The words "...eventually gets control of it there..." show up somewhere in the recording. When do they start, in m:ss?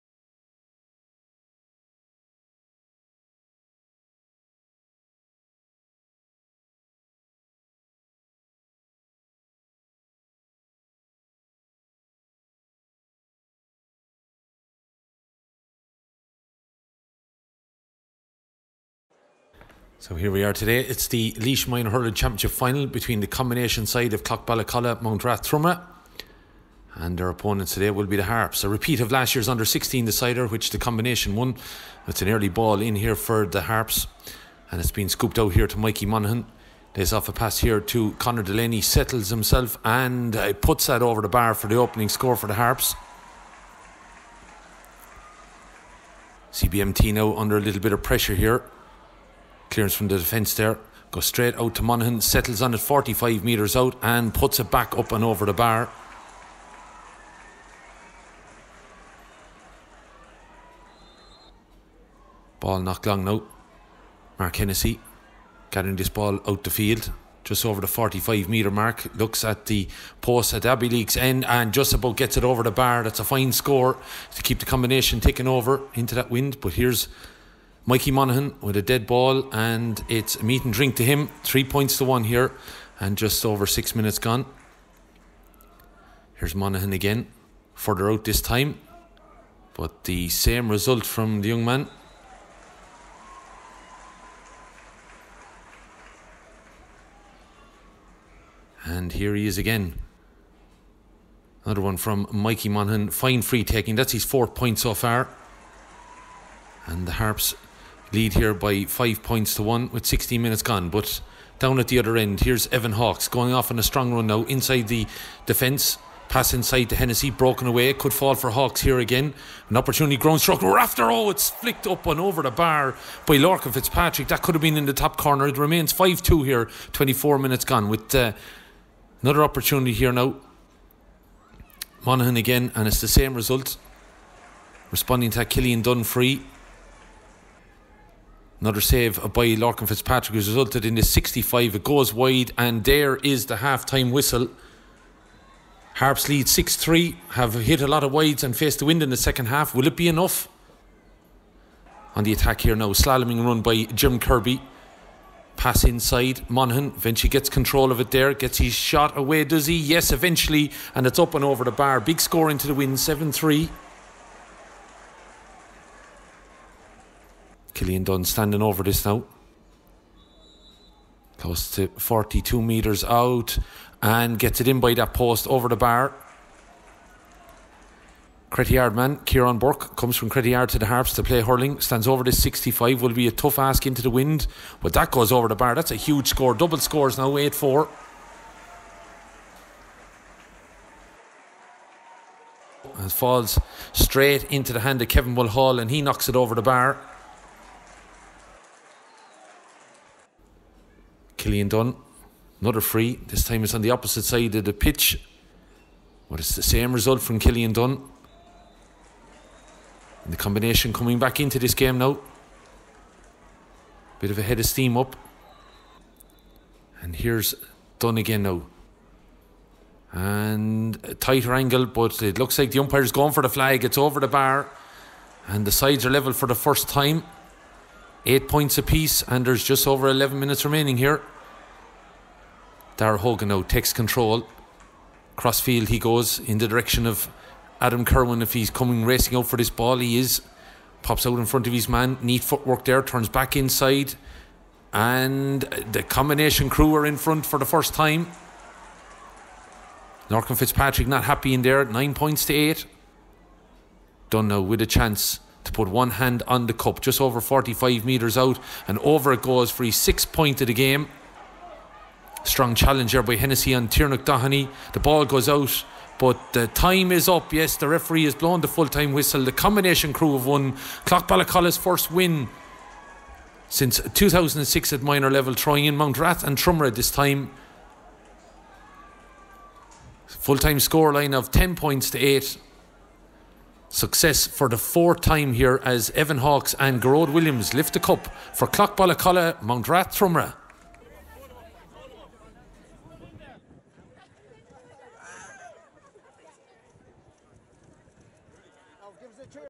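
2:36.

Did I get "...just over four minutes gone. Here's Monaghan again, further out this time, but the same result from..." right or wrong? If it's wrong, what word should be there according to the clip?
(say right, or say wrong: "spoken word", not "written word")
wrong: "six", not "four".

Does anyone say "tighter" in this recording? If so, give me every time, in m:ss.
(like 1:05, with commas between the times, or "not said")
3:41.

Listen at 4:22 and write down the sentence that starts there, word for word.
Strong challenge by Hennessy and Tiernock The ball goes out, but the time is up.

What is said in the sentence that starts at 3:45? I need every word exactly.
And the sides are level for the first time.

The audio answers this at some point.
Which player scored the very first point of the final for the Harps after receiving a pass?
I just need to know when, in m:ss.
0:38.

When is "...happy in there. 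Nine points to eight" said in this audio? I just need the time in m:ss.
4:11.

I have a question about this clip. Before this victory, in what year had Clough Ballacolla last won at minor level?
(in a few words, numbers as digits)
2006.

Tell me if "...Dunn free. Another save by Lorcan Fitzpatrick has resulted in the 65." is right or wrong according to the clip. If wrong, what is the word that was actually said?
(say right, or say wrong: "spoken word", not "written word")
right.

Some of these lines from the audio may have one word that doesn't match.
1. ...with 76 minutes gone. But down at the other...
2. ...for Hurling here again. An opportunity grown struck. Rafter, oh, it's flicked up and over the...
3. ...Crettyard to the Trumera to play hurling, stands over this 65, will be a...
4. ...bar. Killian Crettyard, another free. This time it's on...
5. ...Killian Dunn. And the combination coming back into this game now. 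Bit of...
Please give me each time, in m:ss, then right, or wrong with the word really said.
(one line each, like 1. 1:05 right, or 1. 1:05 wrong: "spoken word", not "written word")
1. 1:49 wrong: "16", not "76"
2. 1:58 wrong: "Hawks", not "Hurling"
3. 3:00 wrong: "Harps", not "Trumera"
4. 3:16 wrong: "Dunn", not "Crettyard"
5. 3:27 right.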